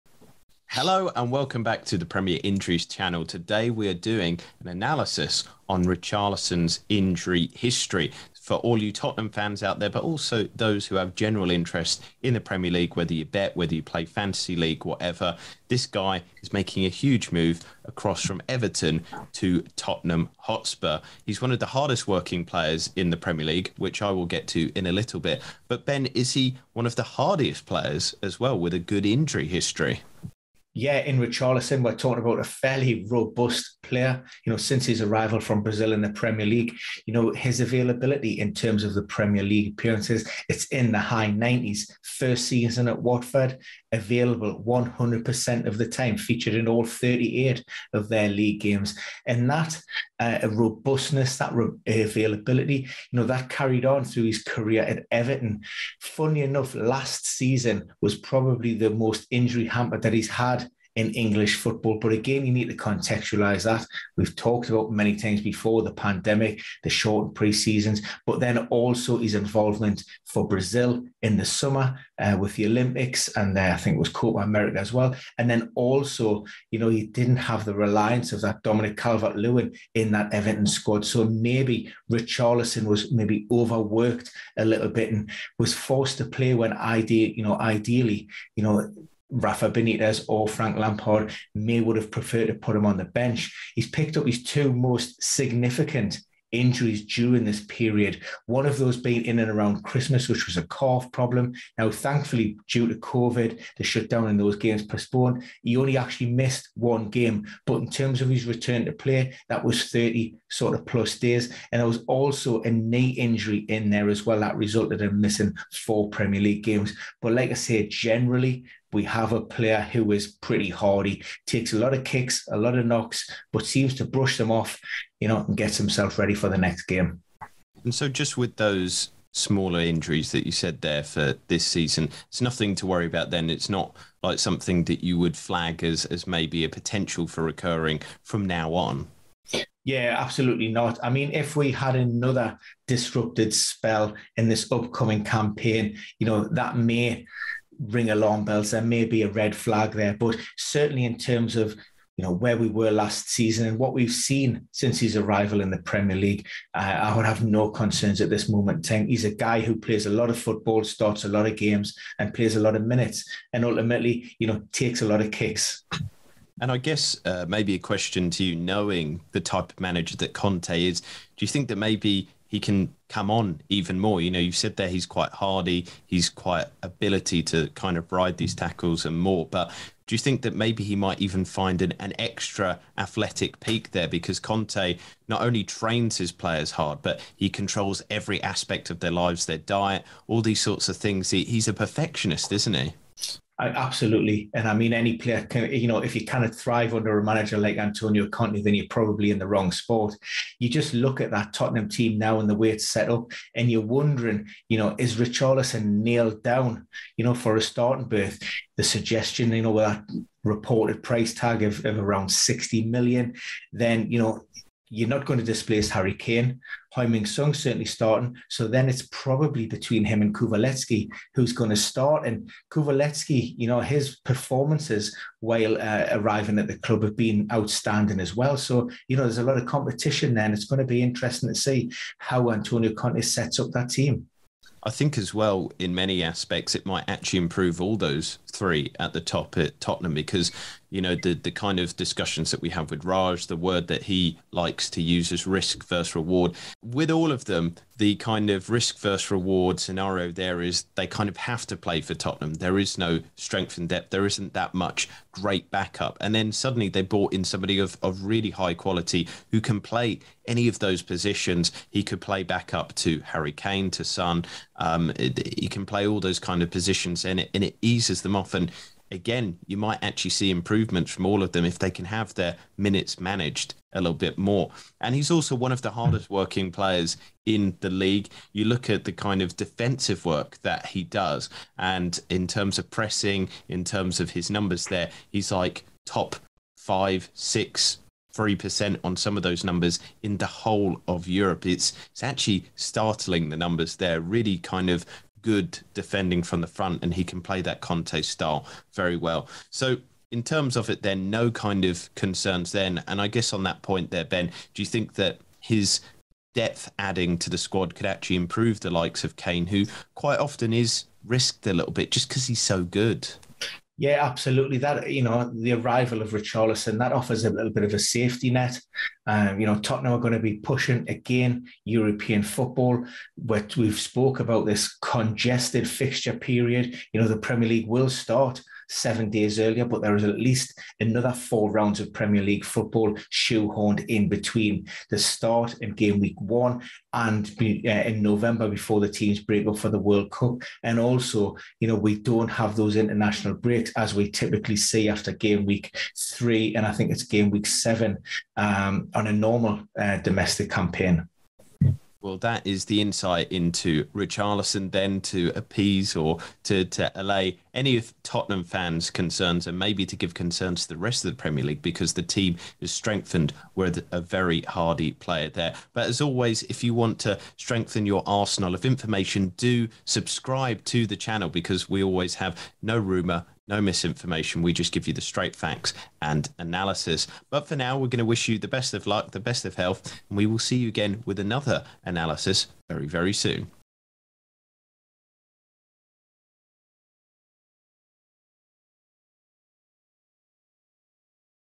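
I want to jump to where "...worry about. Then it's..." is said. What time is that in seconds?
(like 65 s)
132 s.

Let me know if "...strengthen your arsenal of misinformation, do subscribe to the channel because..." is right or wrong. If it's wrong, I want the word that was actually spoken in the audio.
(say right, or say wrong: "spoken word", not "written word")
wrong: "information", not "misinformation".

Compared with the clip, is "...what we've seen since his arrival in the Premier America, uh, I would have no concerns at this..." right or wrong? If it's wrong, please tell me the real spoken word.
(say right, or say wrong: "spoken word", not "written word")
wrong: "League", not "America".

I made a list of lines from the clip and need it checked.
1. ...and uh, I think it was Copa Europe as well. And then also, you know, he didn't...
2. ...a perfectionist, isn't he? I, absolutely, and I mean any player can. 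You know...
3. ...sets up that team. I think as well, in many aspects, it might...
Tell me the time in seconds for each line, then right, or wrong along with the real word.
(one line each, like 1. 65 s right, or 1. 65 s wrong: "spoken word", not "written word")
1. 73 s wrong: "America", not "Europe"
2. 191 s right
3. 233 s right.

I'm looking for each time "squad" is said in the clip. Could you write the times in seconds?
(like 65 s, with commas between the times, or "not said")
80 s, 307 s.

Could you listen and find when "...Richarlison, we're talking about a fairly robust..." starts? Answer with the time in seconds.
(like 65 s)
31 s.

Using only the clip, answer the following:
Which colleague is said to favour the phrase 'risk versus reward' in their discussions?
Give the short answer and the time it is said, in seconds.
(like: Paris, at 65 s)
Raj, at 243 s.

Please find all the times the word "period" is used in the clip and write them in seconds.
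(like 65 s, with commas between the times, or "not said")
97 s, 326 s.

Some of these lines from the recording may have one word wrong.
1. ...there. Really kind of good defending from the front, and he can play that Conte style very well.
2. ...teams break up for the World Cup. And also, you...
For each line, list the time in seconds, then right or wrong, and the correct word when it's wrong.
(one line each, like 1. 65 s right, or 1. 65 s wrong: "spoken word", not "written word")
1. 293 s right
2. 339 s right.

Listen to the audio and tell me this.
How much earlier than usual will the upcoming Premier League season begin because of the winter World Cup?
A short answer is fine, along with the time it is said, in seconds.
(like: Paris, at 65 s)
7 days, at 328 s.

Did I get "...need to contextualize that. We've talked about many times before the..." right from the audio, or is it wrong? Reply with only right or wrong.
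right.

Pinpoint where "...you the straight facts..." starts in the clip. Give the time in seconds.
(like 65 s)
375 s.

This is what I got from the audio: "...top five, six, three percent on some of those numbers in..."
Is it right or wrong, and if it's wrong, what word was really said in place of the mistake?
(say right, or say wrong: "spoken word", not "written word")
right.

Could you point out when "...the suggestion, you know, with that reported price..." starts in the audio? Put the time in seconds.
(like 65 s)
208 s.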